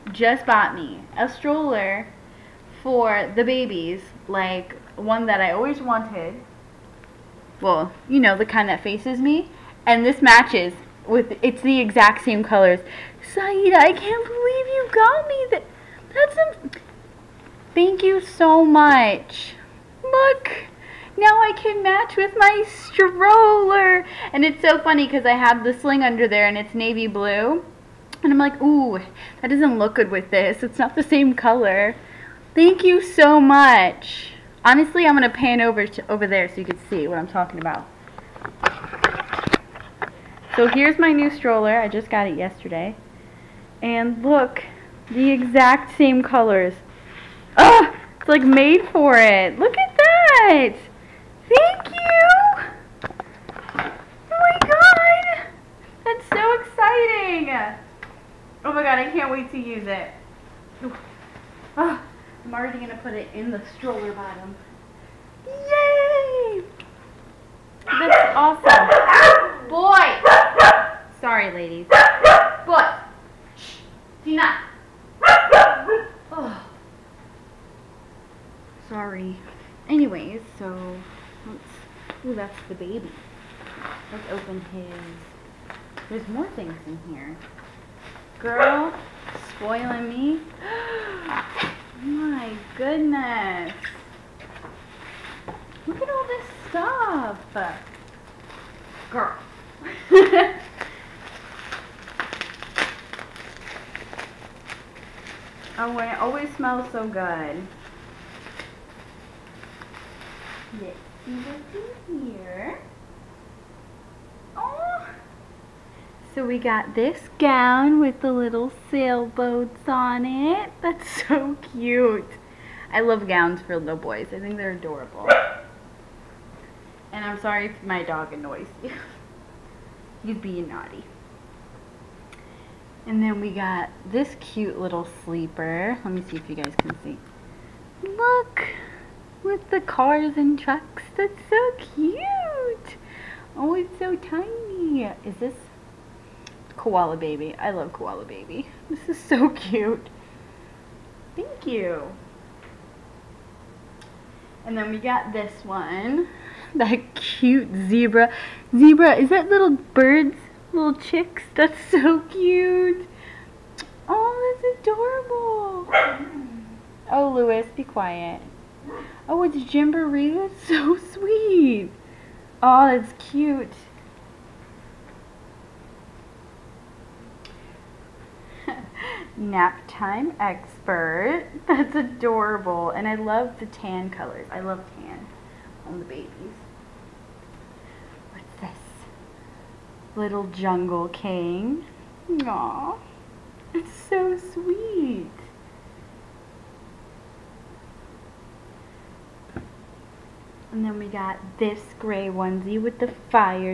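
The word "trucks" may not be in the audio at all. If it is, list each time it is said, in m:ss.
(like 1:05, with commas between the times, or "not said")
2:20.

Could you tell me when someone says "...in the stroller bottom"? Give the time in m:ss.
1:03.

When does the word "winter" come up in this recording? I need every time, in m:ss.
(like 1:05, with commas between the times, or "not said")
not said.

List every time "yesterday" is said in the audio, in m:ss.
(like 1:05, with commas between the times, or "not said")
0:42.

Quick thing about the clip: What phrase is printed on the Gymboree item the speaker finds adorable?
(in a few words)
Nap time expert.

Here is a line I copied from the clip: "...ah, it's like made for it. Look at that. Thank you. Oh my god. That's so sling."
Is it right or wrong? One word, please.
wrong.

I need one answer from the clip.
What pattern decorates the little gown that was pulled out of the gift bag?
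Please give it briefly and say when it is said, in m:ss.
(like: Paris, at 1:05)
sailboats, at 1:58.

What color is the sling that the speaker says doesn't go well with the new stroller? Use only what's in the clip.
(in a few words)
navy blue.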